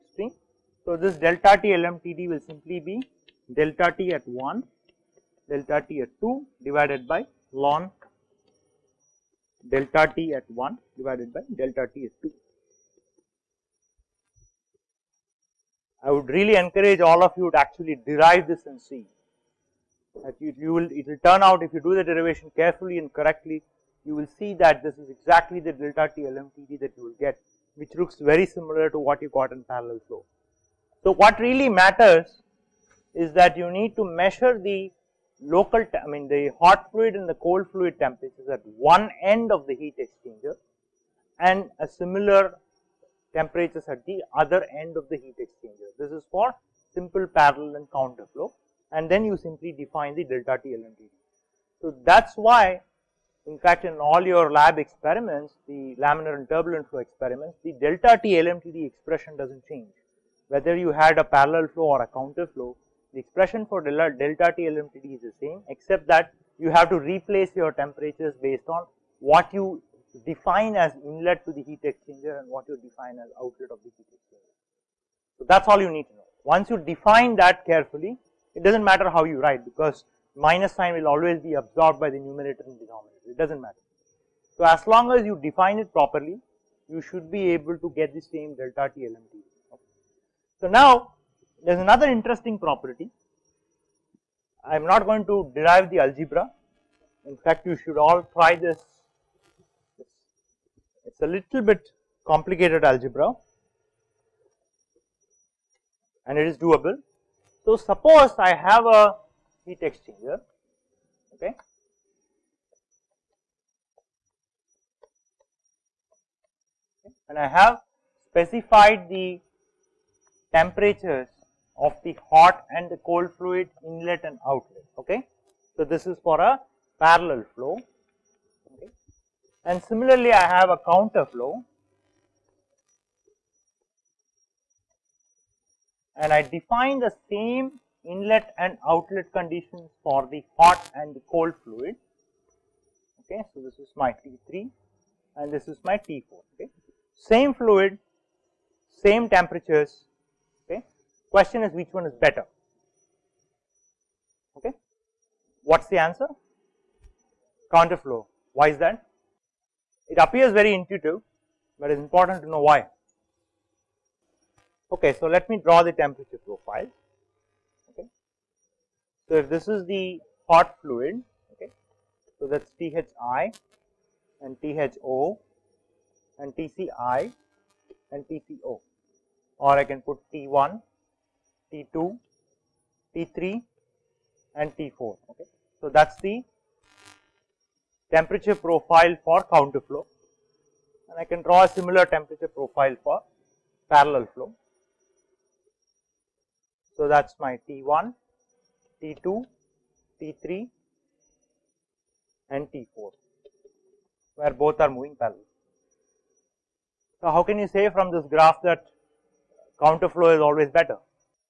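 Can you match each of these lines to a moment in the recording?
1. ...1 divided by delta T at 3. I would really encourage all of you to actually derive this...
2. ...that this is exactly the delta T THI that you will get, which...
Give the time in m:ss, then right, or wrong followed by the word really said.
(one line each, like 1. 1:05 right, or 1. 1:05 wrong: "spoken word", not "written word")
1. 0:10 wrong: "2", not "3"
2. 0:24 wrong: "LMTD", not "THI".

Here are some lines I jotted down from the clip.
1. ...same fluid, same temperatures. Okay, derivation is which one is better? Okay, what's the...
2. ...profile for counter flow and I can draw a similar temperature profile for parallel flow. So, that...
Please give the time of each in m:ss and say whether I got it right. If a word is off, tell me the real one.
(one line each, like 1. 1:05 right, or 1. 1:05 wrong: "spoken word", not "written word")
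1. 2:27 wrong: "question", not "derivation"
2. 3:08 right.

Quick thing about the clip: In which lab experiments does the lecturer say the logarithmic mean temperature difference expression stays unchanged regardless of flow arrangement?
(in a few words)
Laminar and turbulent flow experiments.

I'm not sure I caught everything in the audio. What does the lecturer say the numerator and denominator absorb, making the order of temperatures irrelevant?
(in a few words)
Minus sign.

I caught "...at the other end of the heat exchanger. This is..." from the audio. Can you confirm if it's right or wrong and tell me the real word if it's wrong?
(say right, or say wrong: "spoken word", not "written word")
right.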